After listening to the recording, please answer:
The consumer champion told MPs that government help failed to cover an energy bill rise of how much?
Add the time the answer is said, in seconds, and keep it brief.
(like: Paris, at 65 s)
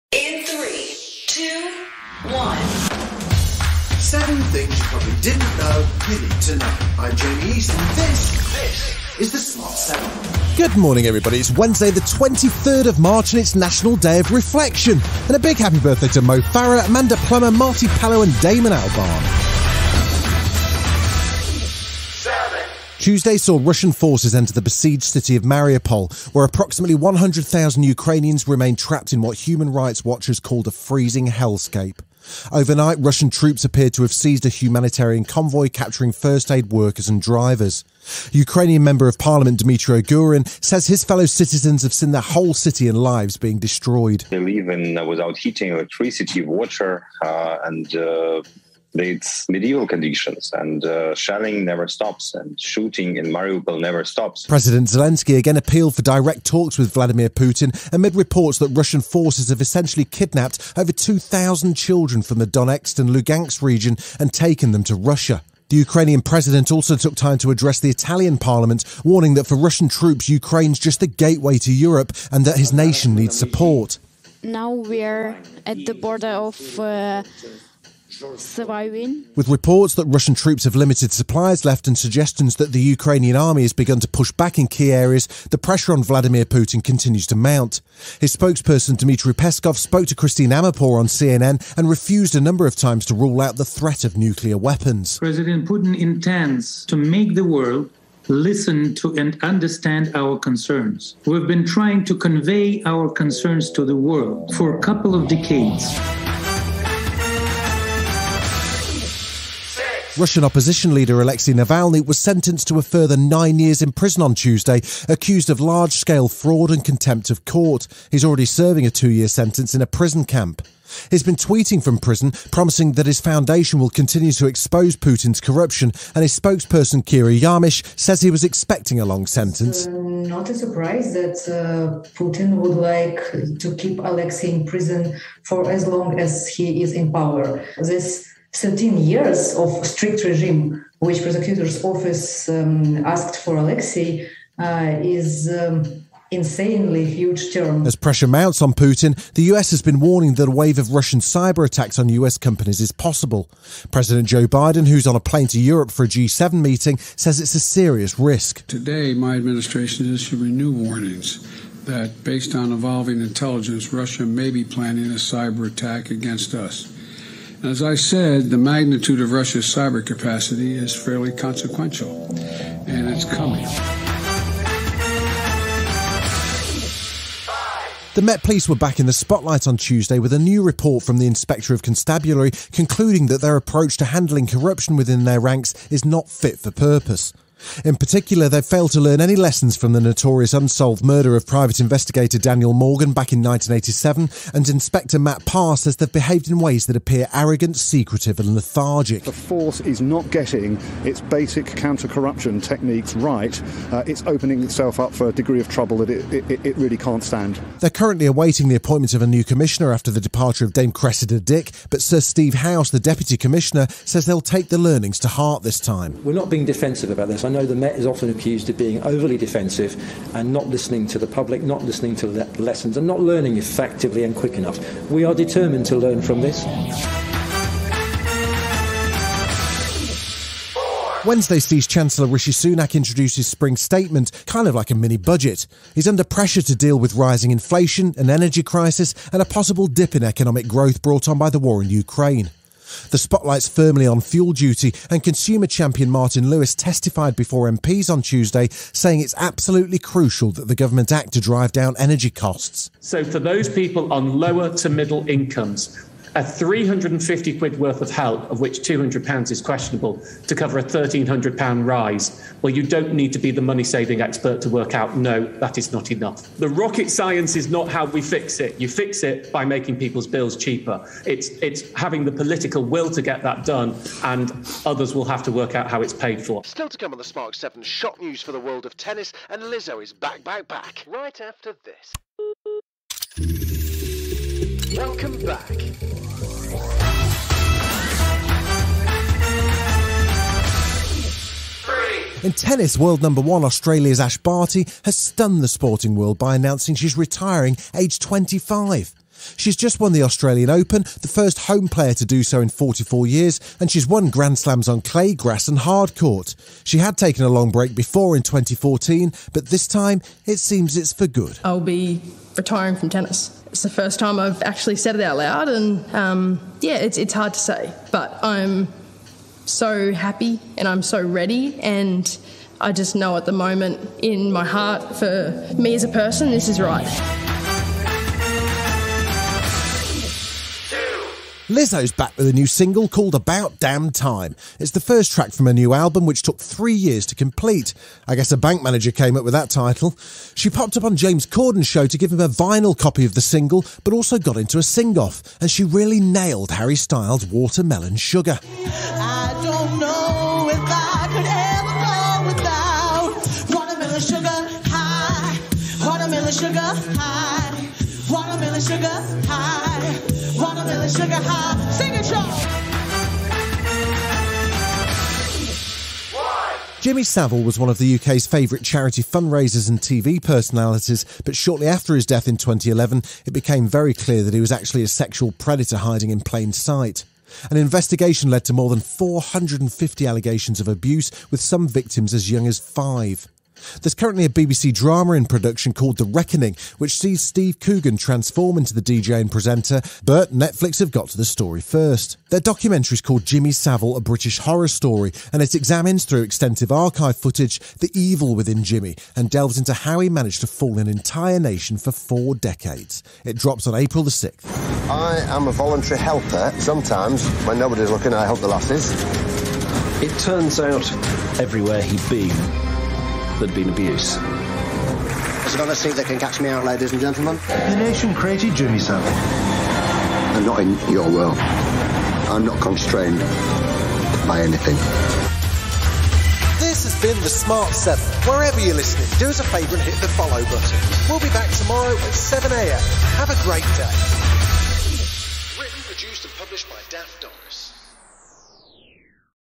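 £1,300, at 260 s.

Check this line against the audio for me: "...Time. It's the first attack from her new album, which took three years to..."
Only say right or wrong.
wrong.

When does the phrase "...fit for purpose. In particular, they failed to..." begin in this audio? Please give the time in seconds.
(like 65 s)
186 s.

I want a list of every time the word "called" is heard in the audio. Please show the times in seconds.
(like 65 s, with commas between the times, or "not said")
30 s, 333 s, 385 s, 393 s.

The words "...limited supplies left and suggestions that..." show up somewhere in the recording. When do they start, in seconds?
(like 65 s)
80 s.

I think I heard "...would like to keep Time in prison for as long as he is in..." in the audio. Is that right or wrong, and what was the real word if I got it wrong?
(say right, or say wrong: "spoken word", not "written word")
wrong: "Alexei", not "Time".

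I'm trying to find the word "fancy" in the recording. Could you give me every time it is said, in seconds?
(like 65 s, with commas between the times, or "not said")
not said.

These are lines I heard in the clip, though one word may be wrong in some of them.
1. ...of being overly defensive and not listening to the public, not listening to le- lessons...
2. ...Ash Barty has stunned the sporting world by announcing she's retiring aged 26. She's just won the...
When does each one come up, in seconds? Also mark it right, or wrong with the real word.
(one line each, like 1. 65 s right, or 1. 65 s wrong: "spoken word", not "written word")
1. 218 s right
2. 294 s wrong: "25", not "26".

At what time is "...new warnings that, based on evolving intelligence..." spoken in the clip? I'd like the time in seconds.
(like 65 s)
160 s.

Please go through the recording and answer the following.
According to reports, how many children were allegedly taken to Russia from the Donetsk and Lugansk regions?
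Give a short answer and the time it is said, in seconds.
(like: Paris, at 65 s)
2,000, at 60 s.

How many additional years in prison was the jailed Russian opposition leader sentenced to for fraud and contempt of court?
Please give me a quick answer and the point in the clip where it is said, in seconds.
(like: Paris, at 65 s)
nine years, at 113 s.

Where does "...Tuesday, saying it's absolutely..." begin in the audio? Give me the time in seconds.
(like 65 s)
248 s.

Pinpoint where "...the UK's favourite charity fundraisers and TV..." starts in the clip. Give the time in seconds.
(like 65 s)
367 s.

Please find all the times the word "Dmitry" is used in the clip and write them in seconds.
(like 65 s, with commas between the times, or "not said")
39 s, 88 s.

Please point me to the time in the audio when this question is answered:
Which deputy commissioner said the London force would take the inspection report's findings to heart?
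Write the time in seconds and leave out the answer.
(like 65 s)
212 s.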